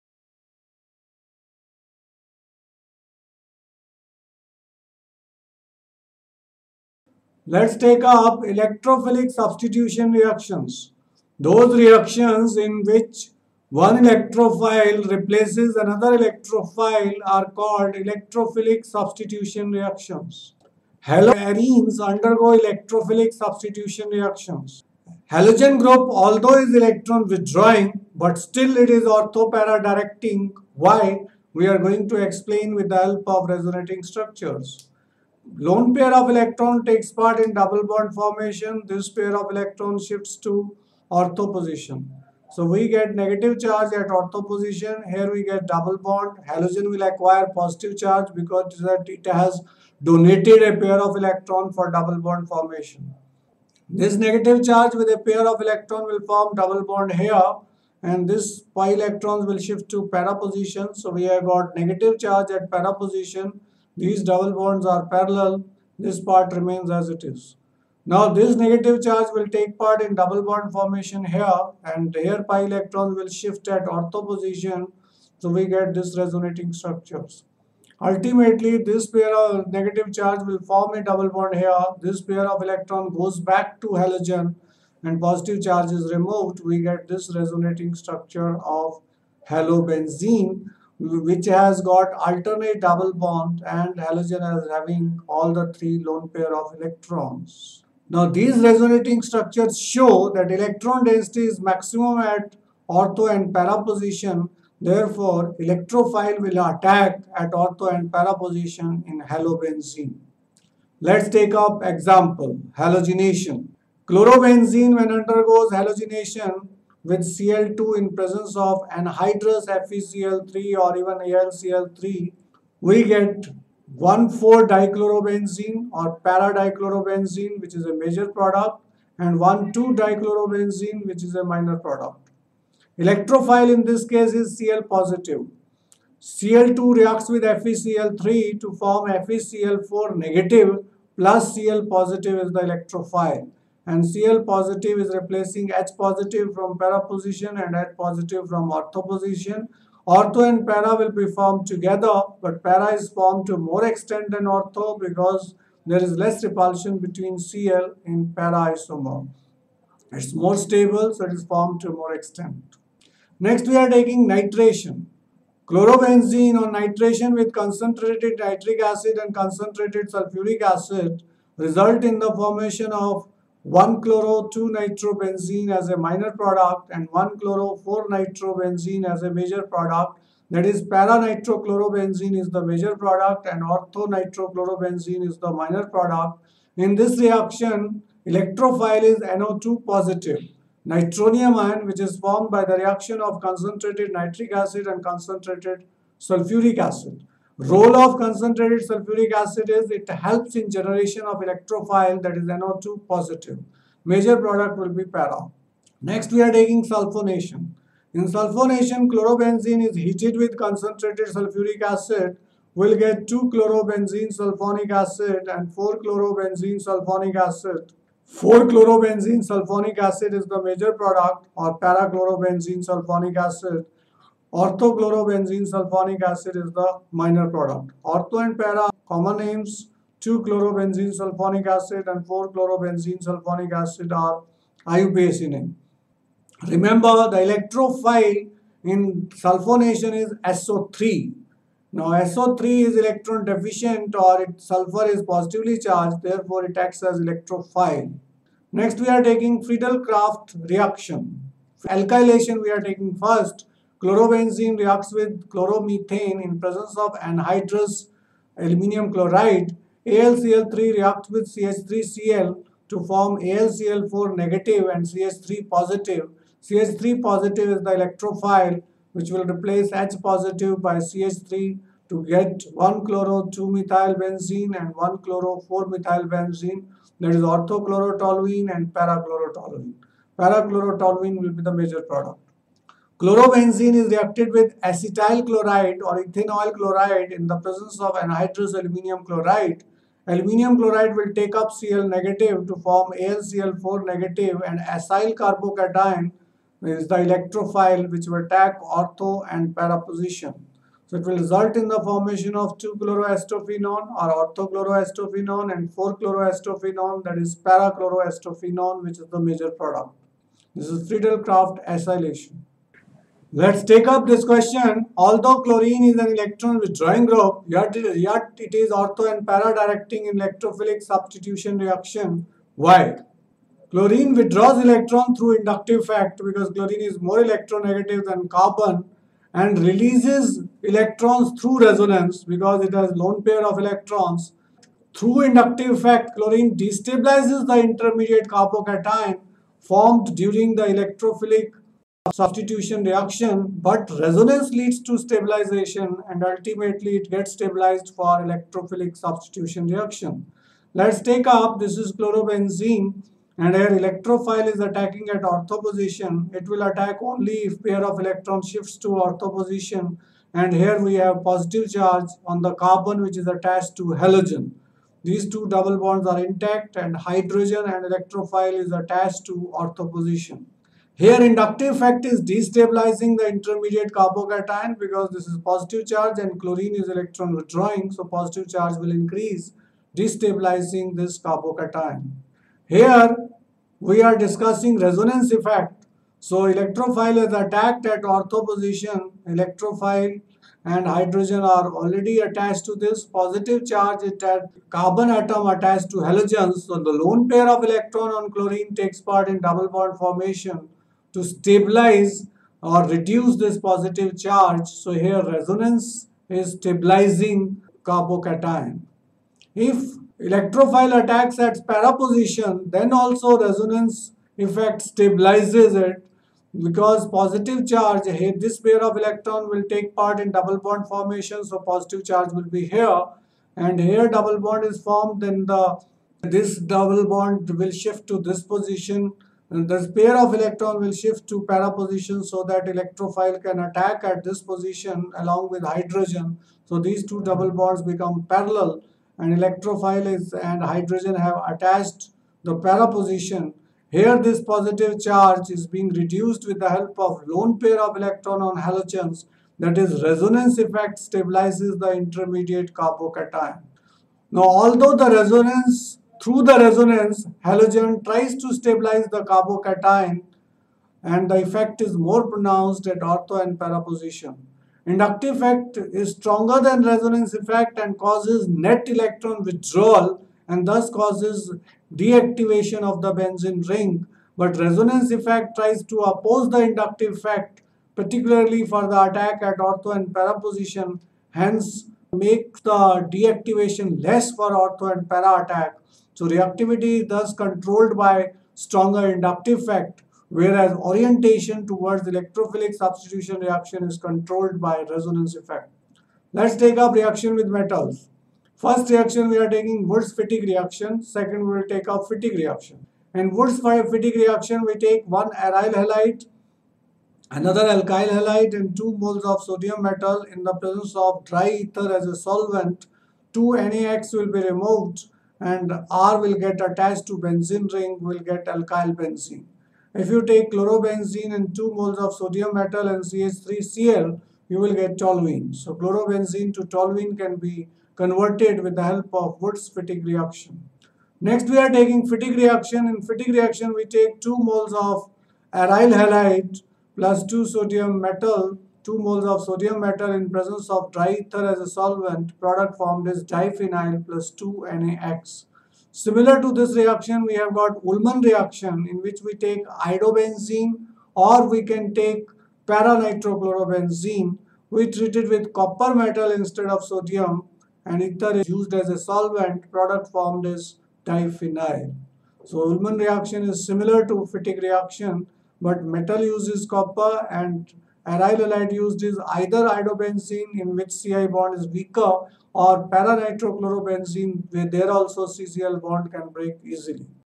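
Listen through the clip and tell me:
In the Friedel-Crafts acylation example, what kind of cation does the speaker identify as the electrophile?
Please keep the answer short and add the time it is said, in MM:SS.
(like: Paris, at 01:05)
acyl carbocation, at 04:54.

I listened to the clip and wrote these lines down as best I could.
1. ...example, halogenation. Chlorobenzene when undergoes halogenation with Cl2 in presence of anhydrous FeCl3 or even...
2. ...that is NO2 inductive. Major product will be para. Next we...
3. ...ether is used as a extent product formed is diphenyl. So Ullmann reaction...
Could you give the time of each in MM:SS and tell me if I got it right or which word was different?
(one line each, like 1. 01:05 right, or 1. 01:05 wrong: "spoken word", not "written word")
1. 01:51 right
2. 03:22 wrong: "positive", not "inductive"
3. 09:18 wrong: "solvent", not "extent".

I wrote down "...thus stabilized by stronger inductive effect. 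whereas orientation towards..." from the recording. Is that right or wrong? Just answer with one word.
wrong.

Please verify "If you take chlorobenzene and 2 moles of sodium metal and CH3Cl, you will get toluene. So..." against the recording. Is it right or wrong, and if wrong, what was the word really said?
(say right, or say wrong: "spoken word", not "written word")
right.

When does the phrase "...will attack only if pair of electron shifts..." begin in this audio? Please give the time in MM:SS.
05:56.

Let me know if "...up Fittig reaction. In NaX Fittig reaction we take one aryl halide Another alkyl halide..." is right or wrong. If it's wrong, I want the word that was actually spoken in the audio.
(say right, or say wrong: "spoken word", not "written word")
wrong: "Wurtz", not "NaX".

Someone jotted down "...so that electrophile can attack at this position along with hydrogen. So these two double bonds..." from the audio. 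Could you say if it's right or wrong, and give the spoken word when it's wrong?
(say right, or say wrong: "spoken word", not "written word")
right.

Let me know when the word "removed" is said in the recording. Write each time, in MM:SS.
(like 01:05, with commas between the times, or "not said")
01:26, 08:34.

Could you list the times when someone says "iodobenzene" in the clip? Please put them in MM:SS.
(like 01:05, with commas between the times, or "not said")
09:10, 09:29.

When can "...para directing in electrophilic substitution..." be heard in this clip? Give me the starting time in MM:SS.
05:19.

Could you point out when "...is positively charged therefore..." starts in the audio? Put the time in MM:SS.
04:05.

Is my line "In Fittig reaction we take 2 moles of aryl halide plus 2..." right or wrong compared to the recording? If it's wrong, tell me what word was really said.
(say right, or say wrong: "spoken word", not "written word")
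right.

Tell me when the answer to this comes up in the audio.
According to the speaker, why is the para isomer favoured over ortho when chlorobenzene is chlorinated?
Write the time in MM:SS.
02:36.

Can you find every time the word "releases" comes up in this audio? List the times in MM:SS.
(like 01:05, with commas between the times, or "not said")
05:29.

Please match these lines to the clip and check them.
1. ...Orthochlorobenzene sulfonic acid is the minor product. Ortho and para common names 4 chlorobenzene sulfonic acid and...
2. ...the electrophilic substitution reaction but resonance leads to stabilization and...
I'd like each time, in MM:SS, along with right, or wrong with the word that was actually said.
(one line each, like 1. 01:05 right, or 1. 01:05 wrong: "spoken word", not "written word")
1. 03:44 wrong: "2", not "4"
2. 05:40 right.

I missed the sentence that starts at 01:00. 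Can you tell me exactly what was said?
So we have got negative charge at para position these double bonds are parallel.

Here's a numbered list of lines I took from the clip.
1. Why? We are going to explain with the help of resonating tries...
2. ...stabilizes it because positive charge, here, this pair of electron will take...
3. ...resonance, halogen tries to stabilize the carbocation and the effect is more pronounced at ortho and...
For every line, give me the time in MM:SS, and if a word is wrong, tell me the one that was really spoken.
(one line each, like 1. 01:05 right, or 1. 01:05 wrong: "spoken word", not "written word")
1. 00:30 wrong: "structures", not "tries"
2. 06:55 right
3. 07:36 right.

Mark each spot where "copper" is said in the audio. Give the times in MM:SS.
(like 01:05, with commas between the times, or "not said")
09:15, 09:26.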